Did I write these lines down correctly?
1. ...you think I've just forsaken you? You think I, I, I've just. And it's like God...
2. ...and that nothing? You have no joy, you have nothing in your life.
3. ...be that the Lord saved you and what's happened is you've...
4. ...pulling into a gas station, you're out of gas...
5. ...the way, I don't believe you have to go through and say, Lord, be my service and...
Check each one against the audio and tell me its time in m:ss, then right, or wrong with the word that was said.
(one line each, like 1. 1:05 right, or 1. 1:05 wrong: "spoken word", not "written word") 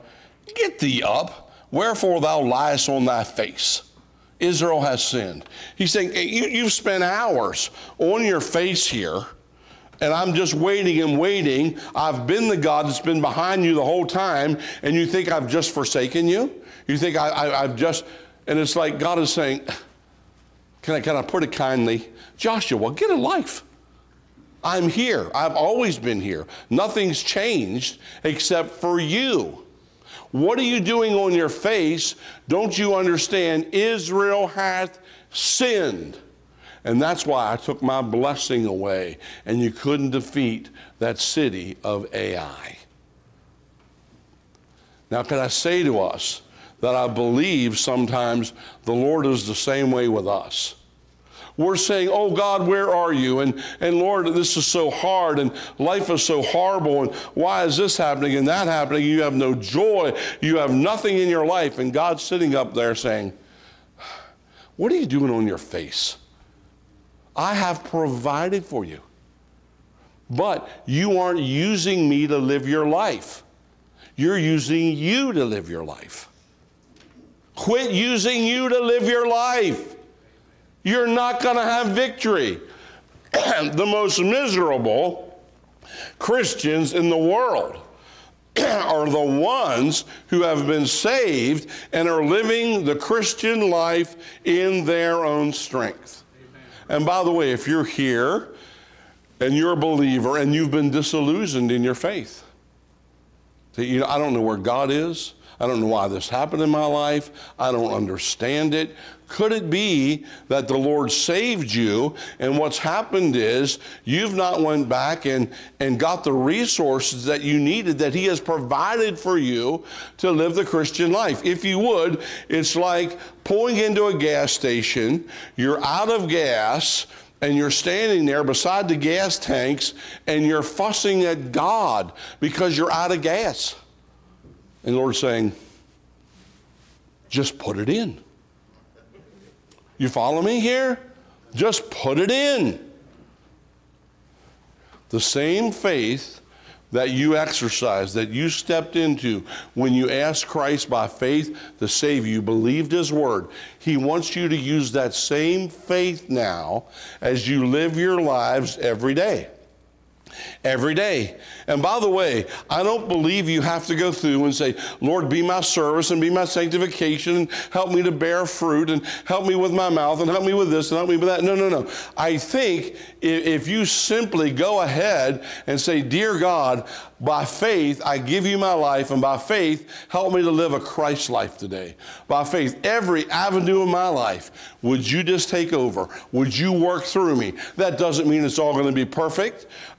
1. 0:14 right
2. 0:58 wrong: "happening", not "nothing"
3. 1:49 right
4. 2:03 right
5. 2:41 right.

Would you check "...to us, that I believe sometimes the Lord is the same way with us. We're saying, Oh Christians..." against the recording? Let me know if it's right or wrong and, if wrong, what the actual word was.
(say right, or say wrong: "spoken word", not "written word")
wrong: "God", not "Christians".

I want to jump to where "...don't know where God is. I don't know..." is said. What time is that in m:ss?
1:44.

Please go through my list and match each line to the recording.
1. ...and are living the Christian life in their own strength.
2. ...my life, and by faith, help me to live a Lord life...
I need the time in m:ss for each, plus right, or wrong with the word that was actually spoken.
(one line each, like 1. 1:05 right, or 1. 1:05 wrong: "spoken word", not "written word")
1. 1:31 right
2. 2:58 wrong: "Christ", not "Lord".